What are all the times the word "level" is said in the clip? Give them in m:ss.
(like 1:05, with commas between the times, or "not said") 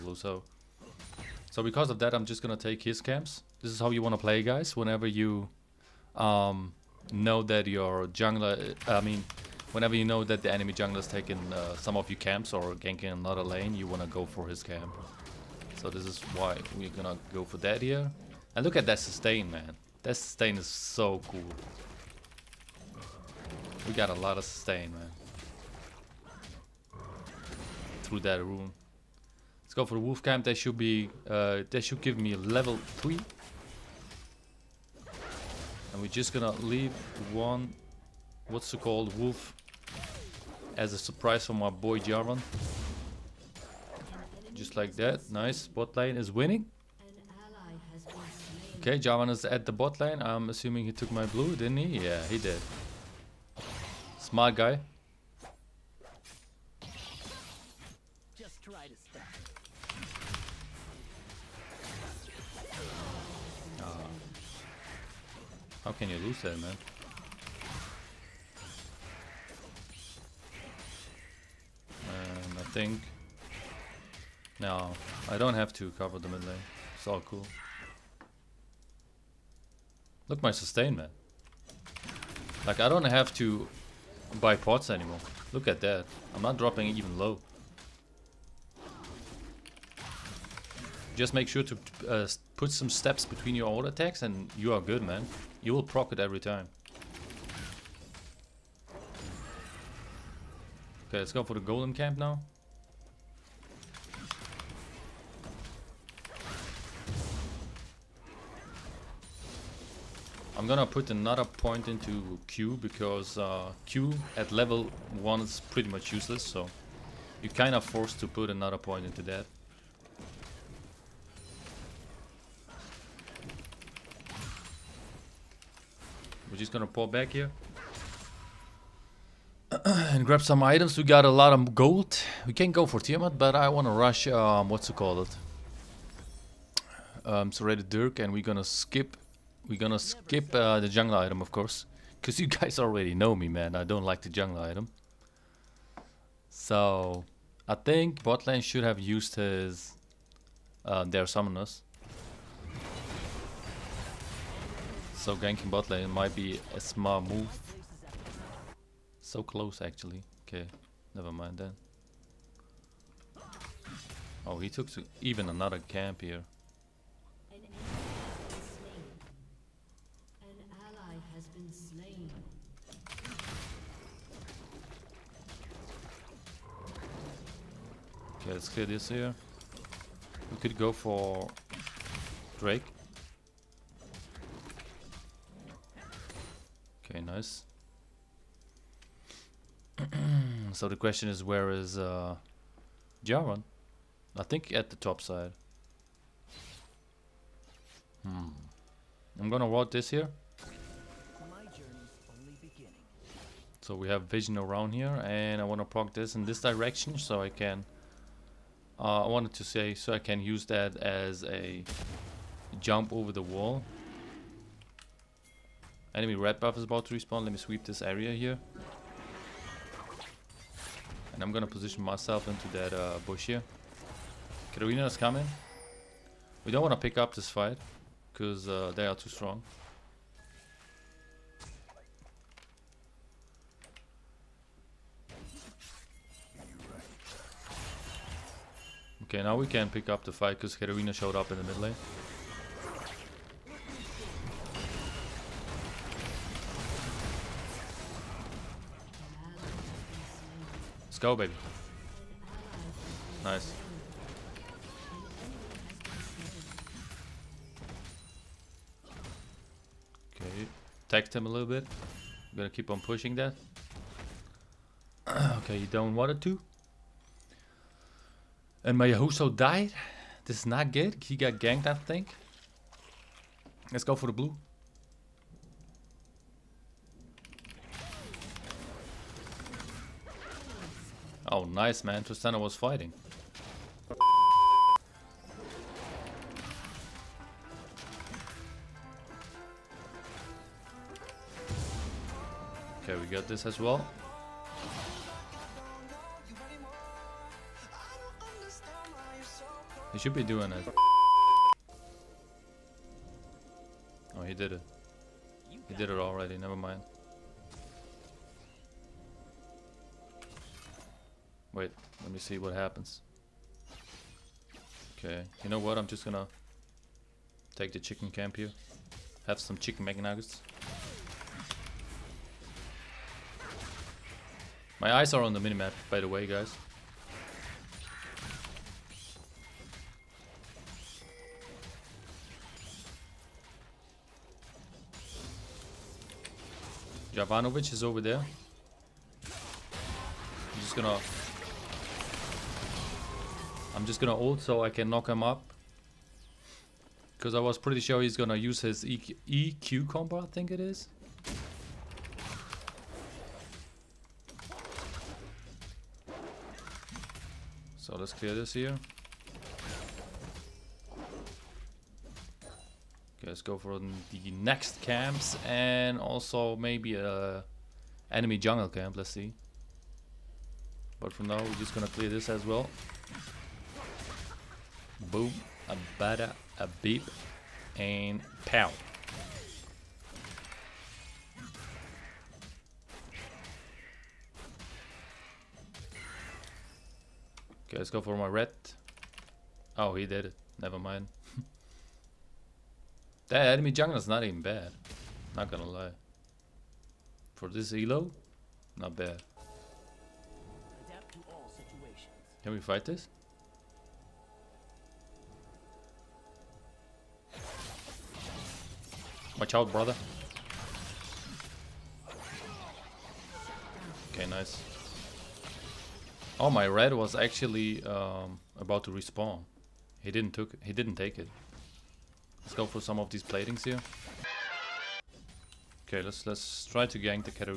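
0:32, 1:54.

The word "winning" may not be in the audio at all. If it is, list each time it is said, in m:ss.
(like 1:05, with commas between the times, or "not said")
0:46.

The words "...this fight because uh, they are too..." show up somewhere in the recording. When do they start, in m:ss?
3:47.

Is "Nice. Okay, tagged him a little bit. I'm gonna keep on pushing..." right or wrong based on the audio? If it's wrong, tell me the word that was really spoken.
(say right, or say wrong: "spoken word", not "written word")
right.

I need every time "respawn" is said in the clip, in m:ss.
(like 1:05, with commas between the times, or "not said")
3:37, 6:59.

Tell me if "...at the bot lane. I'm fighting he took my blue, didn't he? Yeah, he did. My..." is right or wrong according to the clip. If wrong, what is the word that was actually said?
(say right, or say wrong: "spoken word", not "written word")
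wrong: "assuming", not "fighting".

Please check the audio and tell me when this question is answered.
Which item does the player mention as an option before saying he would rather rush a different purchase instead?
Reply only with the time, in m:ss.
2:12.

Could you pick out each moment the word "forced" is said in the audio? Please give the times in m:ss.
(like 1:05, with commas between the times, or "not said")
1:57.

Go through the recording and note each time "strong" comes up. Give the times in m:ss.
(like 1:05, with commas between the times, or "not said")
3:49.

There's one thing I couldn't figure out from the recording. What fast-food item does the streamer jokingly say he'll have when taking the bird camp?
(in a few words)
Chicken McNuggets.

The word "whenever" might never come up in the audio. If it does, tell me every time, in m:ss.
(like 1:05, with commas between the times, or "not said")
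0:04, 0:09.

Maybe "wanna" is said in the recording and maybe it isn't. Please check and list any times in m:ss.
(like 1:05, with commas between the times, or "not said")
0:04, 0:13, 2:13, 3:25.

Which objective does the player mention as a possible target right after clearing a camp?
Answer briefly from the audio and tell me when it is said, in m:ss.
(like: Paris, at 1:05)
Drake, at 3:02.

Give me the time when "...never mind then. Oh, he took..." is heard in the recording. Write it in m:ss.
2:41.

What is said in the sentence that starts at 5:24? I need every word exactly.
My eyes are on the minimap, by the way, guys.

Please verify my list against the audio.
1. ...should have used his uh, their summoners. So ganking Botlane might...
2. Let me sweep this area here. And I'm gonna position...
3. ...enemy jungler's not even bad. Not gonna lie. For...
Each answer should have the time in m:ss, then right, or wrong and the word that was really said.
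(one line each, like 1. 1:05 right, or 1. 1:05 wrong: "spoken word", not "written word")
1. 2:28 right
2. 3:37 right
3. 6:33 right.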